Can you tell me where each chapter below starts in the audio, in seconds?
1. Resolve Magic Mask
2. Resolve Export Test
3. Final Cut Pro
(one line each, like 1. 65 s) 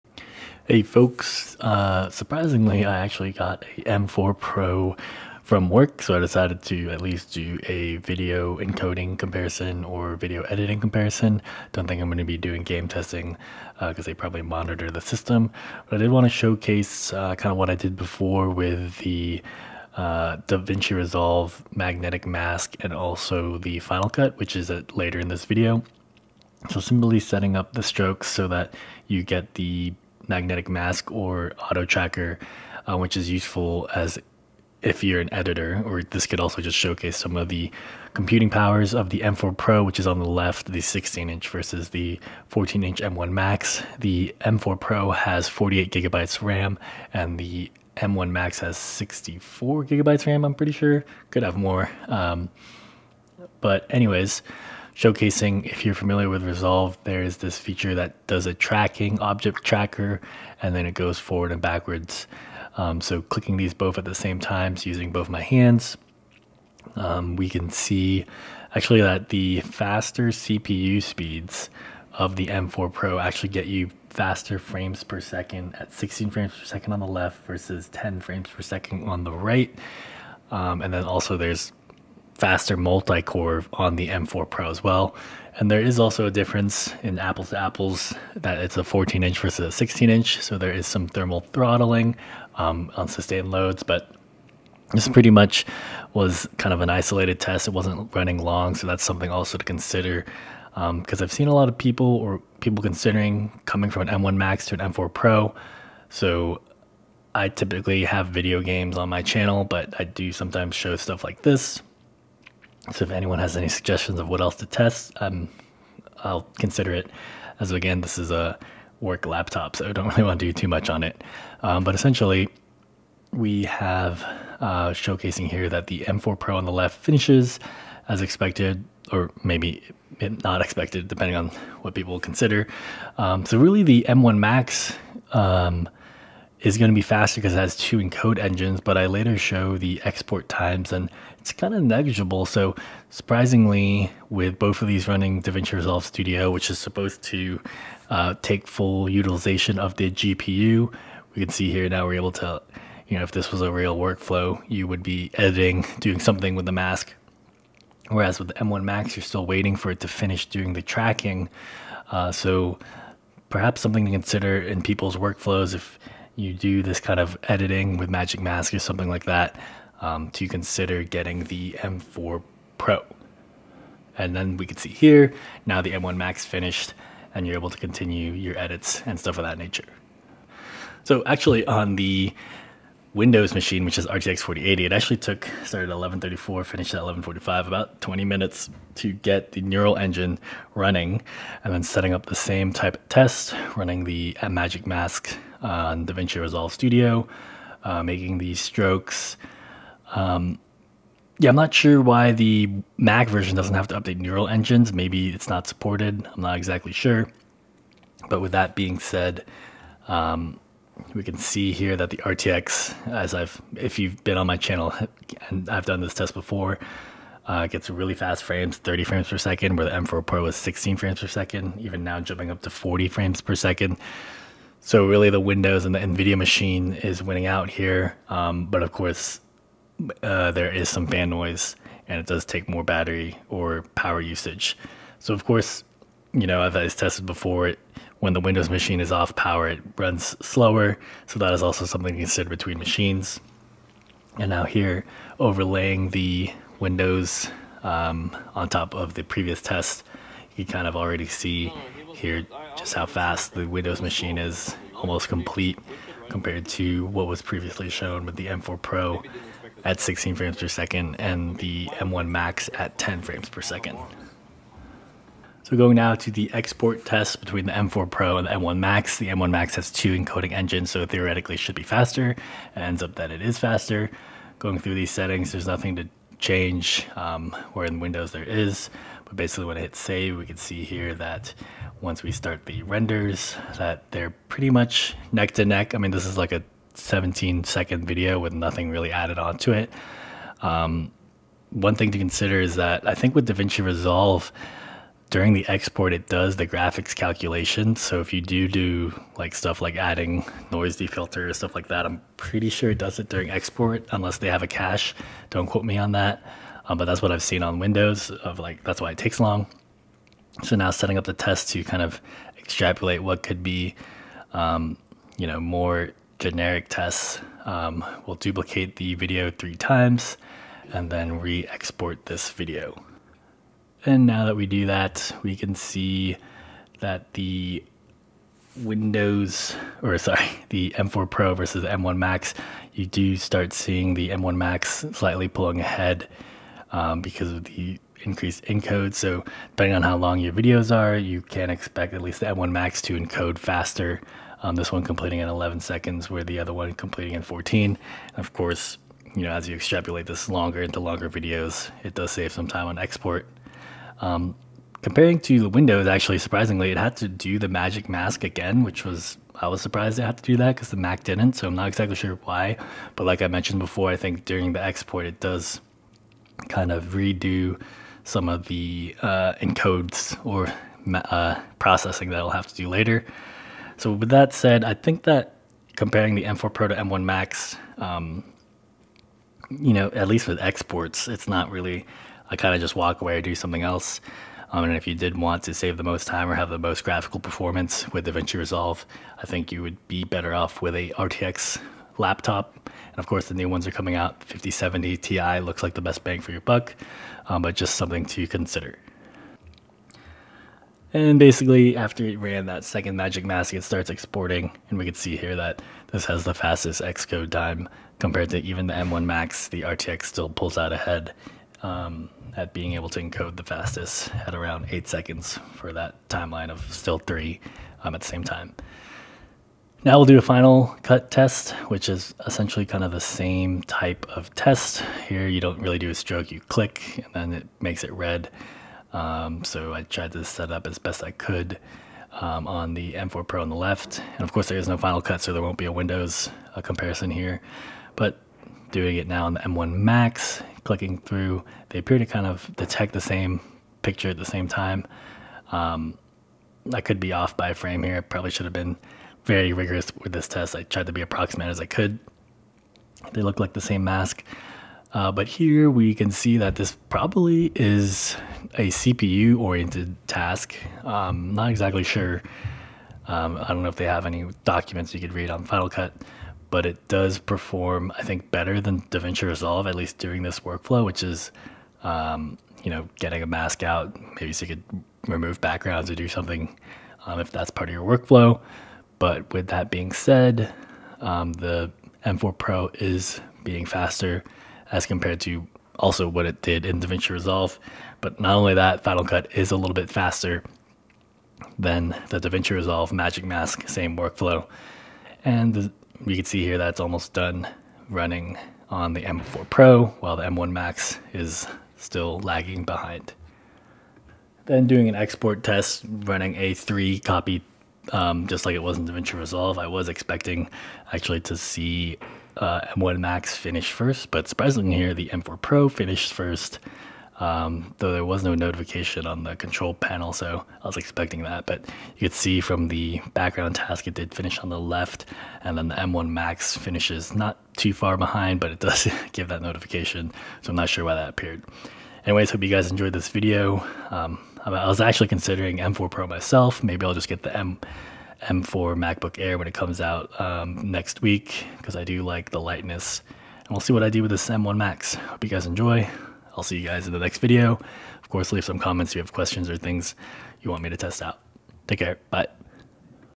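1. 63 s
2. 267 s
3. 419 s.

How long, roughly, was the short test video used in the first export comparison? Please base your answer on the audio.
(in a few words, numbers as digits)
17 seconds.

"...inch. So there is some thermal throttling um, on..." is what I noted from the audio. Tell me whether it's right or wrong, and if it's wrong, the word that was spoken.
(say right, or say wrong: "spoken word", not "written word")
right.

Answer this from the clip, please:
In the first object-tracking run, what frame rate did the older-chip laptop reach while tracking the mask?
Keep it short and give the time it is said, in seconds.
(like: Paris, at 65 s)
10 frames per second, at 77 s.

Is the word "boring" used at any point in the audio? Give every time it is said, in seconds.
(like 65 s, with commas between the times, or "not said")
not said.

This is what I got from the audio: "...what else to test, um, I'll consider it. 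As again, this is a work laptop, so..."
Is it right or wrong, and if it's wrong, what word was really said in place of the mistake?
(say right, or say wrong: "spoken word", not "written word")
right.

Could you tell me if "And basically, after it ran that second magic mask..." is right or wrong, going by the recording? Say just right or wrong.
right.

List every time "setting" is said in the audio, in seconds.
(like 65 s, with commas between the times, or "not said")
27 s, 191 s, 275 s, 310 s.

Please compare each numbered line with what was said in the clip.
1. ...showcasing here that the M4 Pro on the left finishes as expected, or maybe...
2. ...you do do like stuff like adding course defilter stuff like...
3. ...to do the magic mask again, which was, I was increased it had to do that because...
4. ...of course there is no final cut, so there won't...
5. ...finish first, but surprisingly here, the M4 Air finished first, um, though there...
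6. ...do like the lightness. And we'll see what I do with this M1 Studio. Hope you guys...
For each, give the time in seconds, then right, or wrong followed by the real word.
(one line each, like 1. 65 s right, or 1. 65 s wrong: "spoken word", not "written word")
1. 124 s right
2. 298 s wrong: "noise", not "course"
3. 357 s wrong: "surprised", not "increased"
4. 434 s right
5. 513 s wrong: "Pro", not "Air"
6. 542 s wrong: "Max", not "Studio".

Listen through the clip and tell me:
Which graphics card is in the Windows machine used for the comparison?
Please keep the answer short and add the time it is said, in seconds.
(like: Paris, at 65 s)
RTX 4080, at 184 s.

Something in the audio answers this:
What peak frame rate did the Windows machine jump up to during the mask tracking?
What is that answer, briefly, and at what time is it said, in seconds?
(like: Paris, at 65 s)
40 frames per second, at 222 s.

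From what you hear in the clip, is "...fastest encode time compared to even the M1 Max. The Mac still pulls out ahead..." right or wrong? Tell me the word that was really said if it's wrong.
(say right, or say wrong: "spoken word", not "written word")
wrong: "RTX", not "Mac".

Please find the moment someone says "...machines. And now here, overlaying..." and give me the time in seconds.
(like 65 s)
242 s.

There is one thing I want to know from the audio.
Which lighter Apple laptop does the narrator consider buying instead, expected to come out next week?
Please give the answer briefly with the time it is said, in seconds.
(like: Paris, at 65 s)
M4 MacBook Air, at 538 s.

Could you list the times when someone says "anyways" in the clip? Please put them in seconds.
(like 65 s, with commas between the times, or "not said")
53 s, 532 s.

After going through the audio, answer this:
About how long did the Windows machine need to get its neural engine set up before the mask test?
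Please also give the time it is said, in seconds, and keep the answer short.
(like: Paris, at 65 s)
20 minutes, at 187 s.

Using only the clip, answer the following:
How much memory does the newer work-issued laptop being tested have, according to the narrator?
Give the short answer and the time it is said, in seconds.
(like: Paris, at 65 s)
48 GB, at 45 s.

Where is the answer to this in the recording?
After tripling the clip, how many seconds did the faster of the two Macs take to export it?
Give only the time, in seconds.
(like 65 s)
345 s.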